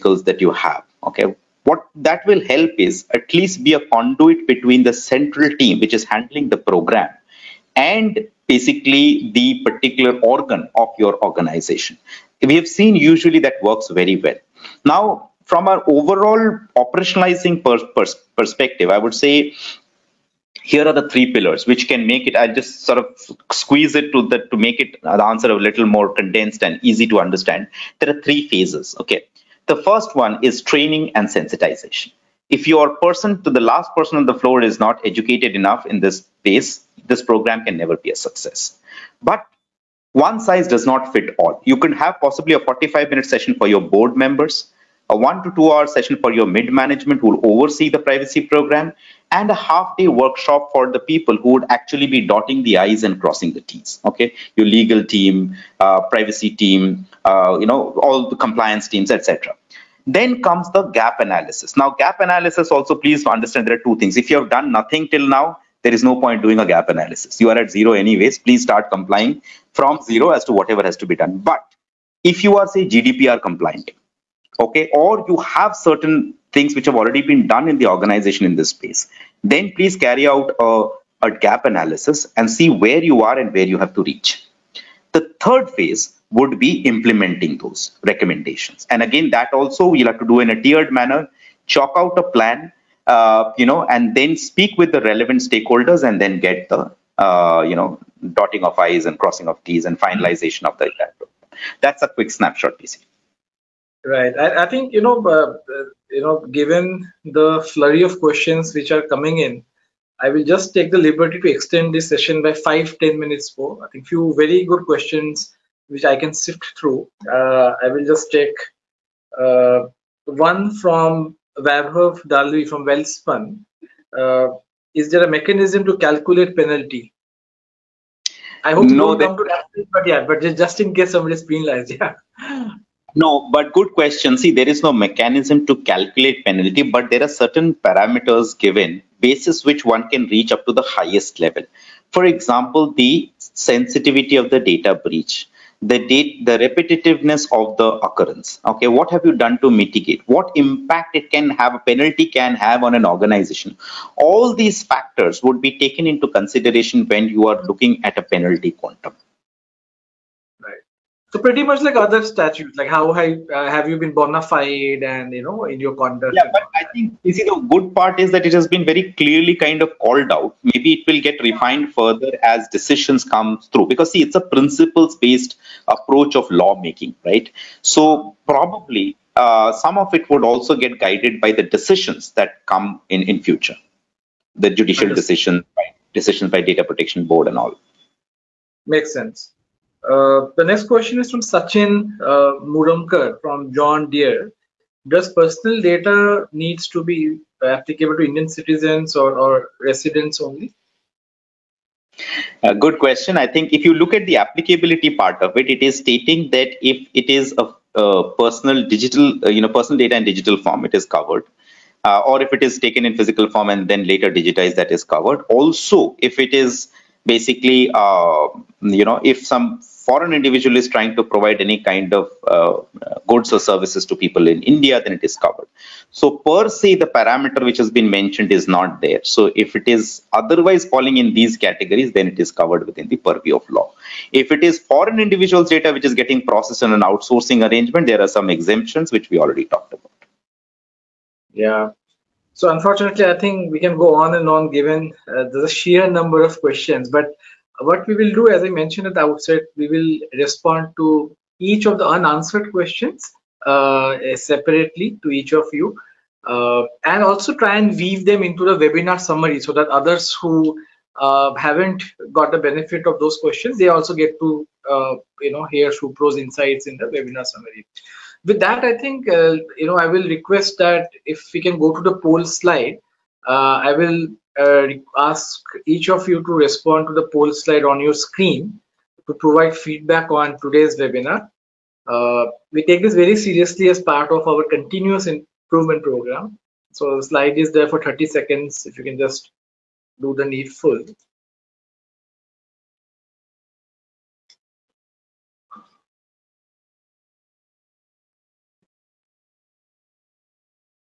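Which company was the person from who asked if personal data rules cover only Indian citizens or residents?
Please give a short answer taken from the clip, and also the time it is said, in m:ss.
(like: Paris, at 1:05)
John Deere, at 3:13.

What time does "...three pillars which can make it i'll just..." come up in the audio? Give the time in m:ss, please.
0:21.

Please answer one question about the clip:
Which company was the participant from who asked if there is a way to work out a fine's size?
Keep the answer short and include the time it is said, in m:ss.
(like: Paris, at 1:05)
Welspun, at 2:02.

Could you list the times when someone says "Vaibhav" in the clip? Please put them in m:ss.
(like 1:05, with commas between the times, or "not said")
2:01.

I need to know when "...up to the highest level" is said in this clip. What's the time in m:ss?
2:20.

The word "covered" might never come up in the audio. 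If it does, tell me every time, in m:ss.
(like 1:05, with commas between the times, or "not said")
3:31, 3:35, 3:45, 3:52.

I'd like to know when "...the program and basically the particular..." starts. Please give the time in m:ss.
0:06.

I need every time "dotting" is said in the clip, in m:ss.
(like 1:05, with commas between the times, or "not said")
0:52, 1:38.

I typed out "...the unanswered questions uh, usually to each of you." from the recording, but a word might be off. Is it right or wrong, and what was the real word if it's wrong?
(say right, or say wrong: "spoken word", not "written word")
wrong: "separately", not "usually".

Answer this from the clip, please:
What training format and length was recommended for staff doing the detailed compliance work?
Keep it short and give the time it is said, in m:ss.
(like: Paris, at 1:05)
half day workshop, at 0:49.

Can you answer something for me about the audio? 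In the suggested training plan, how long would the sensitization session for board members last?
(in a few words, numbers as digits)
45 minutes.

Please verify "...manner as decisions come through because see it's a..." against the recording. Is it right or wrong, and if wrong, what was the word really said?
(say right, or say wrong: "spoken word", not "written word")
wrong: "further", not "manner".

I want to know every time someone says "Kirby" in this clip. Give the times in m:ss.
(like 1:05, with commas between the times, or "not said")
not said.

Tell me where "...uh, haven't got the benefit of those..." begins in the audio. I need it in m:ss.
4:21.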